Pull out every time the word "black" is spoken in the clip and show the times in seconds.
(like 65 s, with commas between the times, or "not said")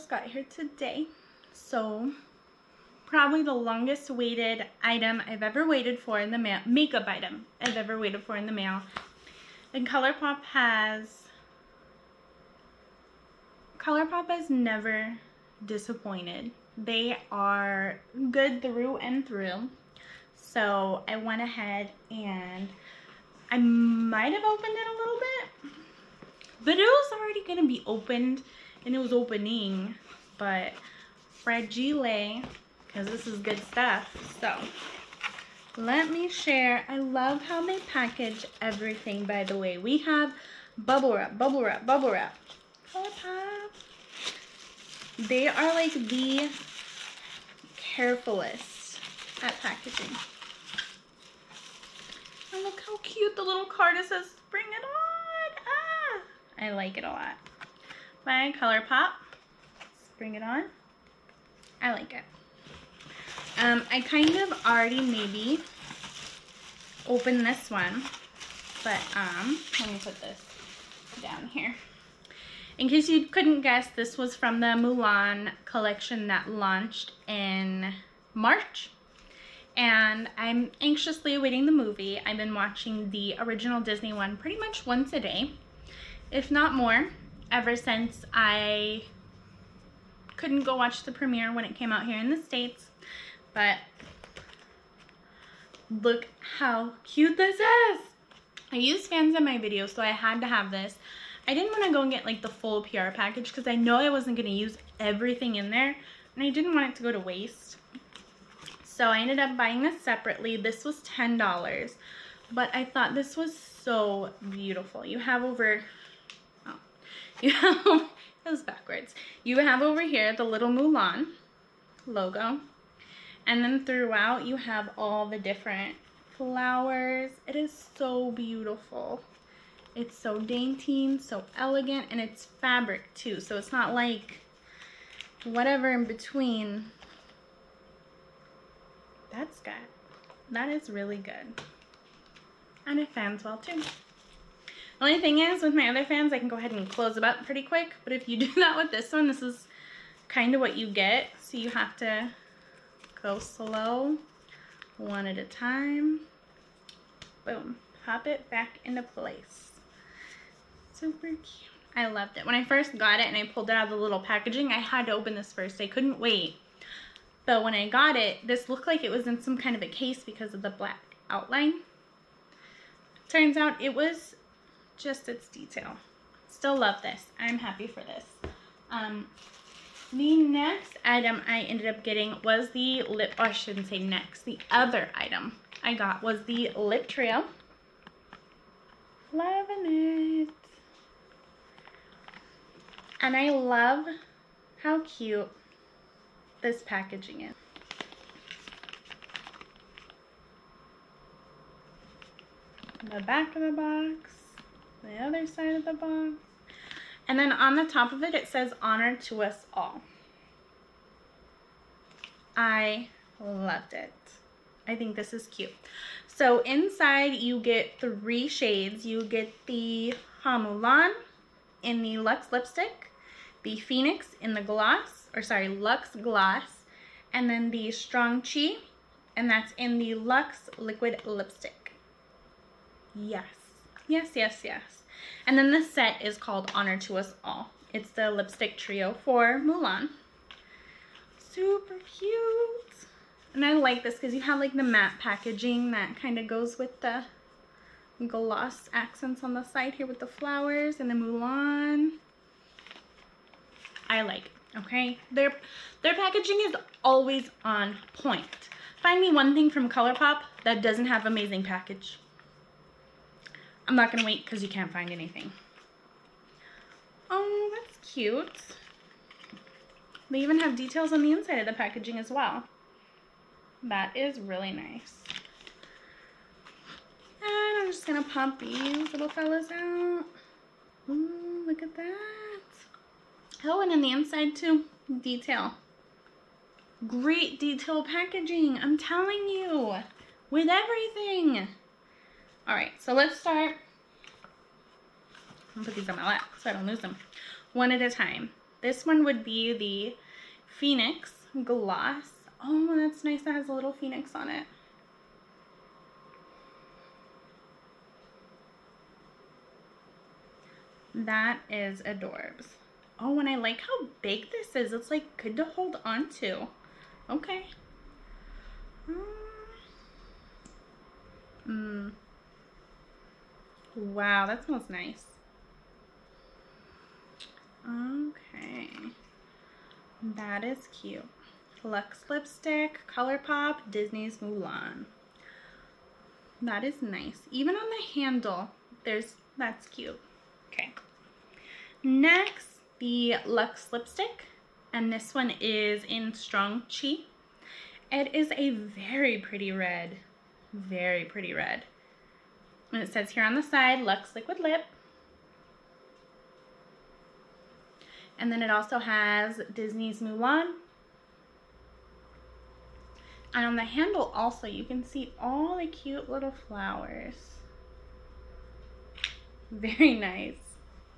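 170 s.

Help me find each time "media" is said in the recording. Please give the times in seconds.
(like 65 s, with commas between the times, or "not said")
not said.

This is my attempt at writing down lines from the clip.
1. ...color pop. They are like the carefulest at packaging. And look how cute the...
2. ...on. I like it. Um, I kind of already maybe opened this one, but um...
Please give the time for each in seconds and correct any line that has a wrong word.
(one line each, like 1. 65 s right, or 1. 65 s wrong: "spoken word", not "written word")
1. 42 s right
2. 60 s right.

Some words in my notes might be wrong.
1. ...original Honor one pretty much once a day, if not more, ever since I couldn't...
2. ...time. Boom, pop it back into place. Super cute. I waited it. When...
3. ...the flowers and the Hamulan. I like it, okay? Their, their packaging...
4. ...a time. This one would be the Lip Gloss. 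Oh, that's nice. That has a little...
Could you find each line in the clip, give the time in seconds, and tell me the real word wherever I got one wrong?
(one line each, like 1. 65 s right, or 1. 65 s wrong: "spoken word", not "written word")
1. 83 s wrong: "Disney", not "Honor"
2. 155 s wrong: "loved", not "waited"
3. 250 s wrong: "Mulan", not "Hamulan"
4. 298 s wrong: "Phoenix", not "Lip".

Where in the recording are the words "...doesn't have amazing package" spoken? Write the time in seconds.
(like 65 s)
260 s.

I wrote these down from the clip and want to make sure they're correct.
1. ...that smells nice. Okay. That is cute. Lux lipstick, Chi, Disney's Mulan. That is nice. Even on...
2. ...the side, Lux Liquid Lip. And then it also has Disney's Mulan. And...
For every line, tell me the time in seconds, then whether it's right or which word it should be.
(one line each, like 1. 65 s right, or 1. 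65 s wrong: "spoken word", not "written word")
1. 324 s wrong: "ColourPop", not "Chi"
2. 353 s right.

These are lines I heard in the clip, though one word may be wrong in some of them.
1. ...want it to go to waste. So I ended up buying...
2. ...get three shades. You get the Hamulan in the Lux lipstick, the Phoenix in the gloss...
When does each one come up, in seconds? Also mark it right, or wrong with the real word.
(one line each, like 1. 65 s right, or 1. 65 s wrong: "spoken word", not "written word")
1. 106 s right
2. 217 s right.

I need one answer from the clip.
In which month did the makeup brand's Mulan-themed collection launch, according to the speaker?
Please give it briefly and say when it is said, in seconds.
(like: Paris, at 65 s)
March, at 78 s.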